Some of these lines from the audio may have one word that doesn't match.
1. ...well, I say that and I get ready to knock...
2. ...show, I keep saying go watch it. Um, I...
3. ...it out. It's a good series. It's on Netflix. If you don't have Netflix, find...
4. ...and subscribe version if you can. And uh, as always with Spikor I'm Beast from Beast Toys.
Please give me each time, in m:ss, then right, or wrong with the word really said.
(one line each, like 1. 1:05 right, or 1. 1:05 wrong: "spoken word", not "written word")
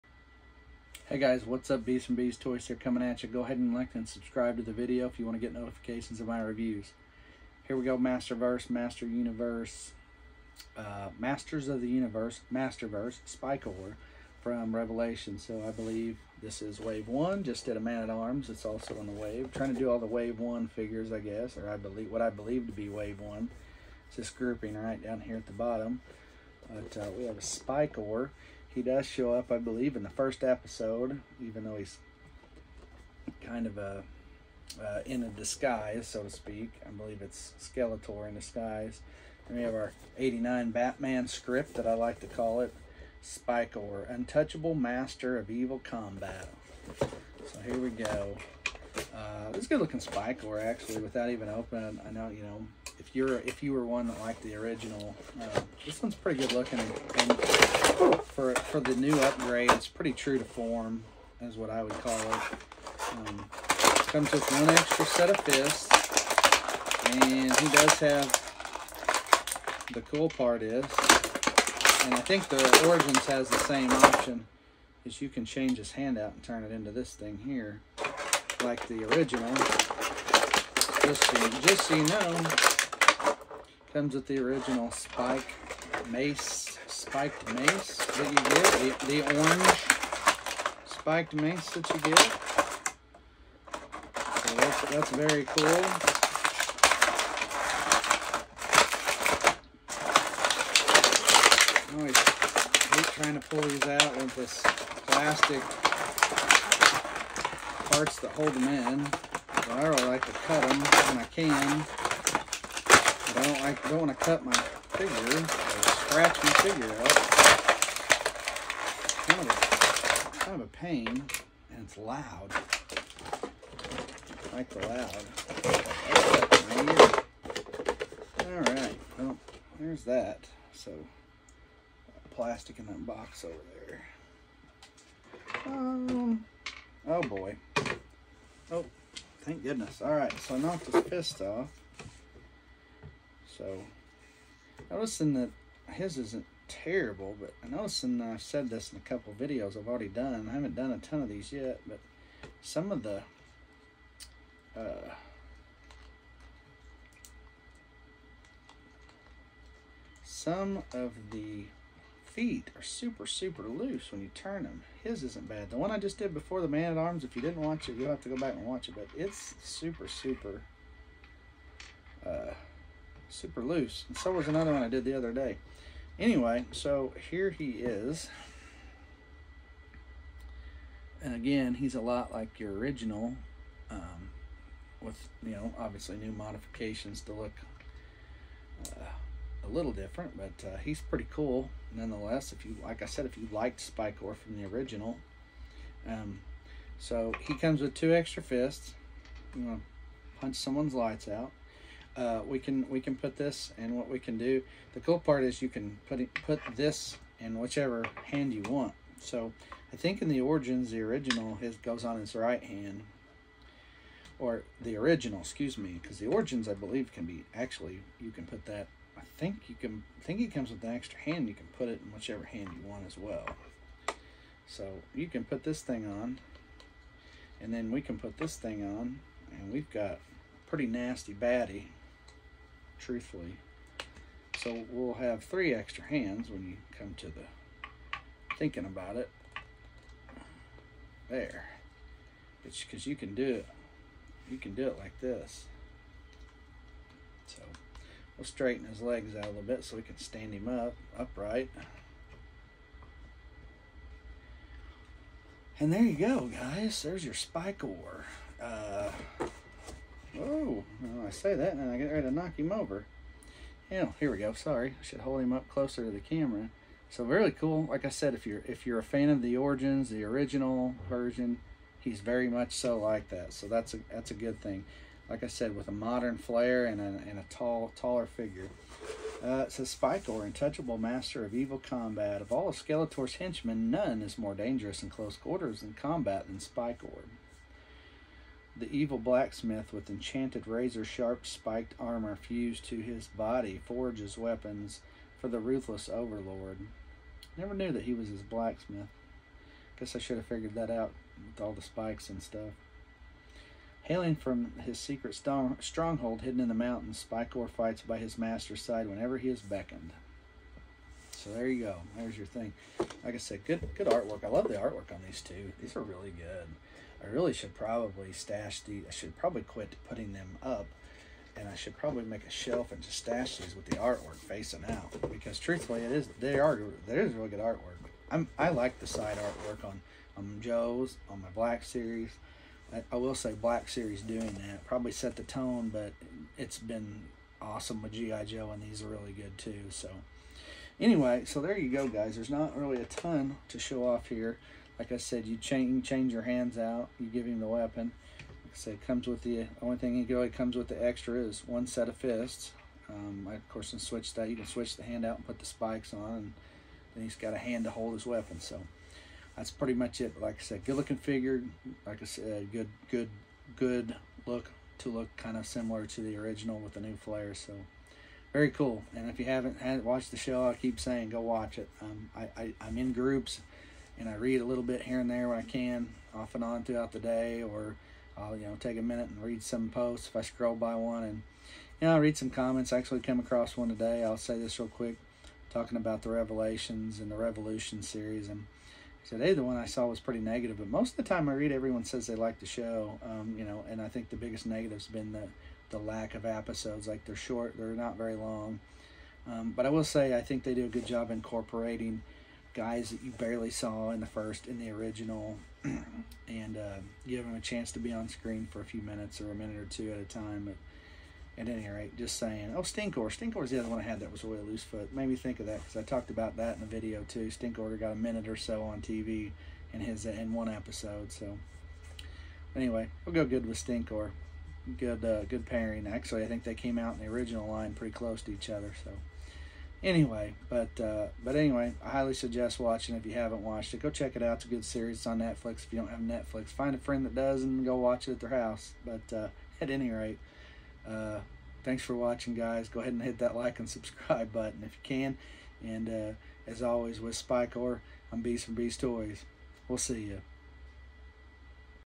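1. 4:21 right
2. 6:10 right
3. 7:14 right
4. 7:23 wrong: "button", not "version".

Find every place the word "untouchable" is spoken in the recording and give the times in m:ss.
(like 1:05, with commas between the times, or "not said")
0:44, 4:40.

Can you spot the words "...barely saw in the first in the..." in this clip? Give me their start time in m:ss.
6:43.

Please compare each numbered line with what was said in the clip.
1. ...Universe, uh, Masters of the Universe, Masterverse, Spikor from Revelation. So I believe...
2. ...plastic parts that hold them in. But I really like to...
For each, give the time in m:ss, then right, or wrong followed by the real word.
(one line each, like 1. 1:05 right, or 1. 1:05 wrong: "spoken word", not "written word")
1. 0:09 right
2. 1:45 right.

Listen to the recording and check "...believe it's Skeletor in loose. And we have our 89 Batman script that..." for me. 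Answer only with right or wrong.
wrong.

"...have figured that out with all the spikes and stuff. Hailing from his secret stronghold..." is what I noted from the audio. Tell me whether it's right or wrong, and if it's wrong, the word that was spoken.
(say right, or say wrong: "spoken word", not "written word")
right.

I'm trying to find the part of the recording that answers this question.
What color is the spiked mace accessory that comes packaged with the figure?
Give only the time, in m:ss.
1:29.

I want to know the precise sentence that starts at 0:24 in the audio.
It's this grouping right down here at the bottom.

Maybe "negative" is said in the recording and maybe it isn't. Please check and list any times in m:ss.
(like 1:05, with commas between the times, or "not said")
6:30, 6:34.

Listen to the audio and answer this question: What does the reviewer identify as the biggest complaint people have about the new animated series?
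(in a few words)
Lack of episodes.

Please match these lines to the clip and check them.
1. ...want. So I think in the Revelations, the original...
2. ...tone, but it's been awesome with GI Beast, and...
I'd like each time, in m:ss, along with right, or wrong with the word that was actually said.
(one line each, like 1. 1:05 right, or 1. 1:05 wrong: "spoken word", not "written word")
1. 3:28 wrong: "Origins", not "Revelations"
2. 5:35 wrong: "Joe", not "Beast".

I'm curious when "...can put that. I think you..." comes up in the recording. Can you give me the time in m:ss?
3:38.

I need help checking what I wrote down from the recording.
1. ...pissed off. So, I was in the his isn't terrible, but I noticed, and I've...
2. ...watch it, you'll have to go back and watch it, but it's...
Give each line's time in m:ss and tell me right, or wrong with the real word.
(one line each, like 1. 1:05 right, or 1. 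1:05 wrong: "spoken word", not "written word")
1. 2:21 right
2. 2:47 right.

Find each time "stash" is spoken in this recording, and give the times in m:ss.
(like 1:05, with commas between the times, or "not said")
5:18, 5:23.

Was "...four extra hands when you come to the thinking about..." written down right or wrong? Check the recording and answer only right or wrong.
wrong.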